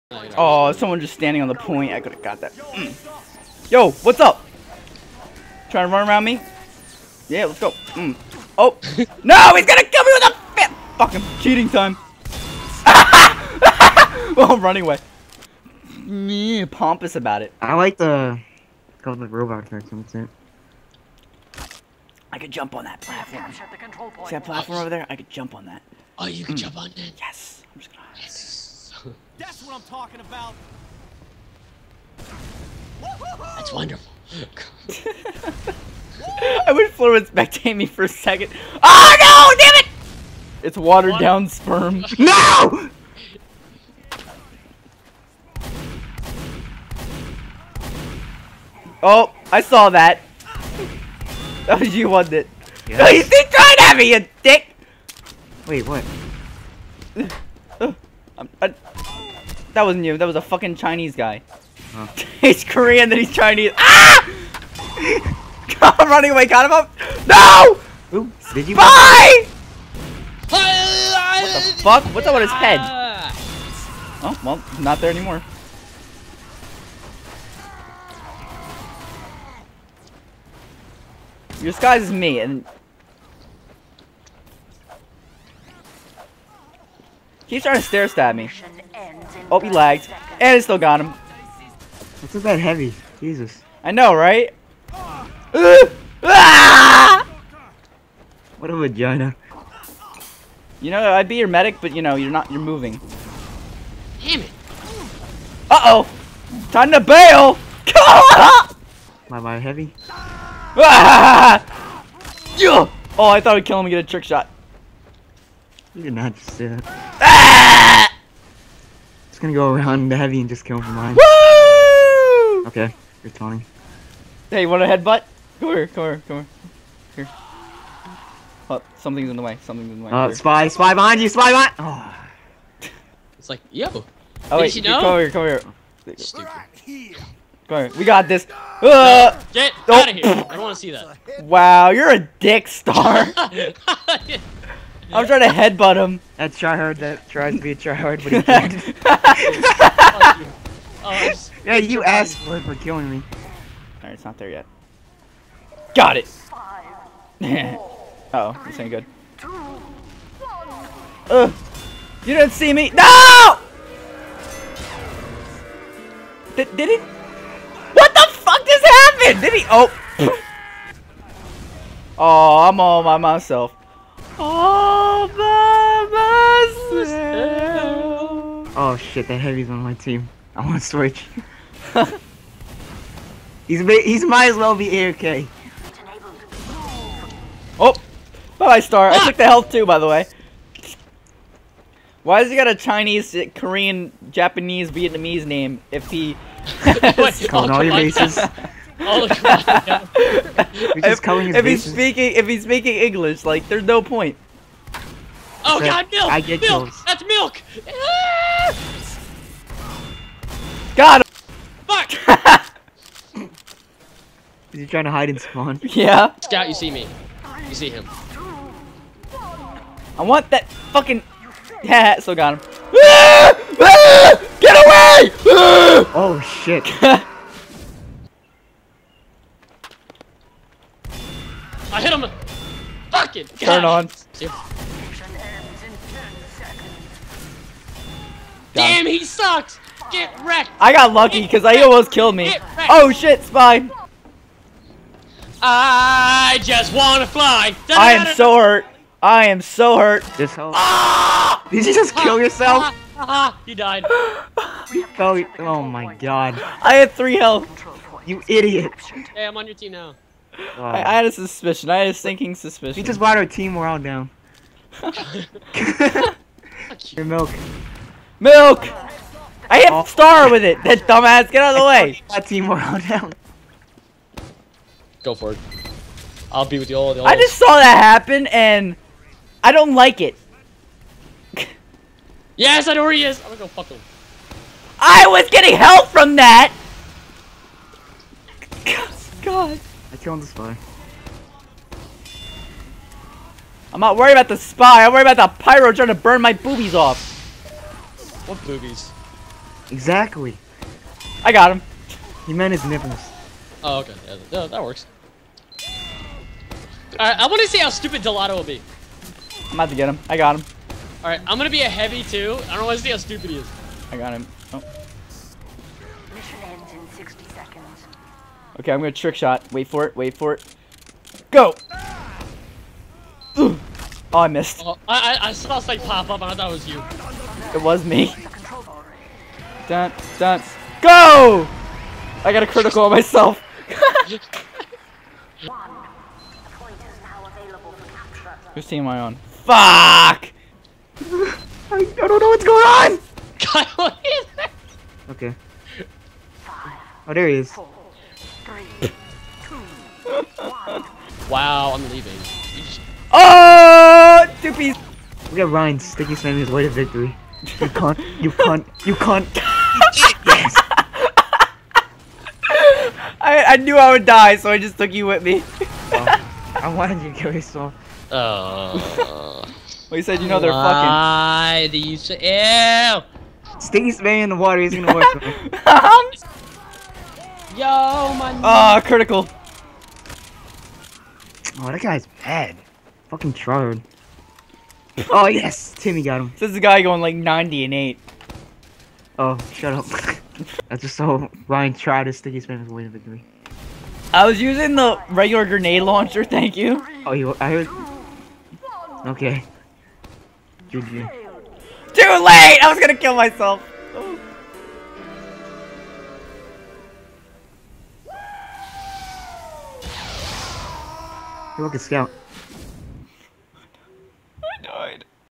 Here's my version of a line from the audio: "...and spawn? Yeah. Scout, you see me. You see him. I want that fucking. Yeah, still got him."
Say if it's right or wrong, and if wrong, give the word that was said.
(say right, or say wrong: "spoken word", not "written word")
right.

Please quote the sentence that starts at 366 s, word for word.
oh, I wanted you to kill yourself.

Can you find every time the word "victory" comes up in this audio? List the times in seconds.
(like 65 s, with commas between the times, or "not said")
356 s, 393 s.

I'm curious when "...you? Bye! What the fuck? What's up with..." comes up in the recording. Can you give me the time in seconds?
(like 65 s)
68 s.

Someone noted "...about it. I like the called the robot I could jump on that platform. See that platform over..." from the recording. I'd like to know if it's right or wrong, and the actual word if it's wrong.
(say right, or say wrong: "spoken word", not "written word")
right.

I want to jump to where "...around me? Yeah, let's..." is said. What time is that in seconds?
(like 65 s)
6 s.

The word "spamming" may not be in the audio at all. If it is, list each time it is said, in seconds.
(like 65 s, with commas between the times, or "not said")
356 s, 374 s.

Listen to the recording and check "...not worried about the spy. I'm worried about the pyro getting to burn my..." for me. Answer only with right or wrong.
wrong.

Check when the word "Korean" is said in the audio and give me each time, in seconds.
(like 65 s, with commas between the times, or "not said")
62 s, 193 s.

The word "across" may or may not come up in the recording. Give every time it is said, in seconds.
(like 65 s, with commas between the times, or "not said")
199 s.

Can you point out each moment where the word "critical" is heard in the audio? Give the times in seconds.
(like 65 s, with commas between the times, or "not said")
332 s, 379 s.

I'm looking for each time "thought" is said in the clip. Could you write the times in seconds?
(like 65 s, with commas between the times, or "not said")
113 s, 326 s.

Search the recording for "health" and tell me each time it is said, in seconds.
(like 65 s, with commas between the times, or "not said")
189 s, 257 s.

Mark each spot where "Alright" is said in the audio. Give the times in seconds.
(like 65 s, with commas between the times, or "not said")
154 s, 307 s, 311 s.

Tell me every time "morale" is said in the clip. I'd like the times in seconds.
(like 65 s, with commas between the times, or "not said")
263 s, 272 s.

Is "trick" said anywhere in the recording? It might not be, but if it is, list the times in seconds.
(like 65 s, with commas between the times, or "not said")
114 s, 319 s.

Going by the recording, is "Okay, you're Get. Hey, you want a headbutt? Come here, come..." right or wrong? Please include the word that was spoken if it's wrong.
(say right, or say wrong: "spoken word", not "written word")
wrong: "Tony", not "Get".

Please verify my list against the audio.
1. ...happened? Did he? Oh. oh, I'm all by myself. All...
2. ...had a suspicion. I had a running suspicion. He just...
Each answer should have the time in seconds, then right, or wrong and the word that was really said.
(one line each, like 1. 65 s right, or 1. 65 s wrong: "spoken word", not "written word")
1. 168 s right
2. 261 s wrong: "sinking", not "running".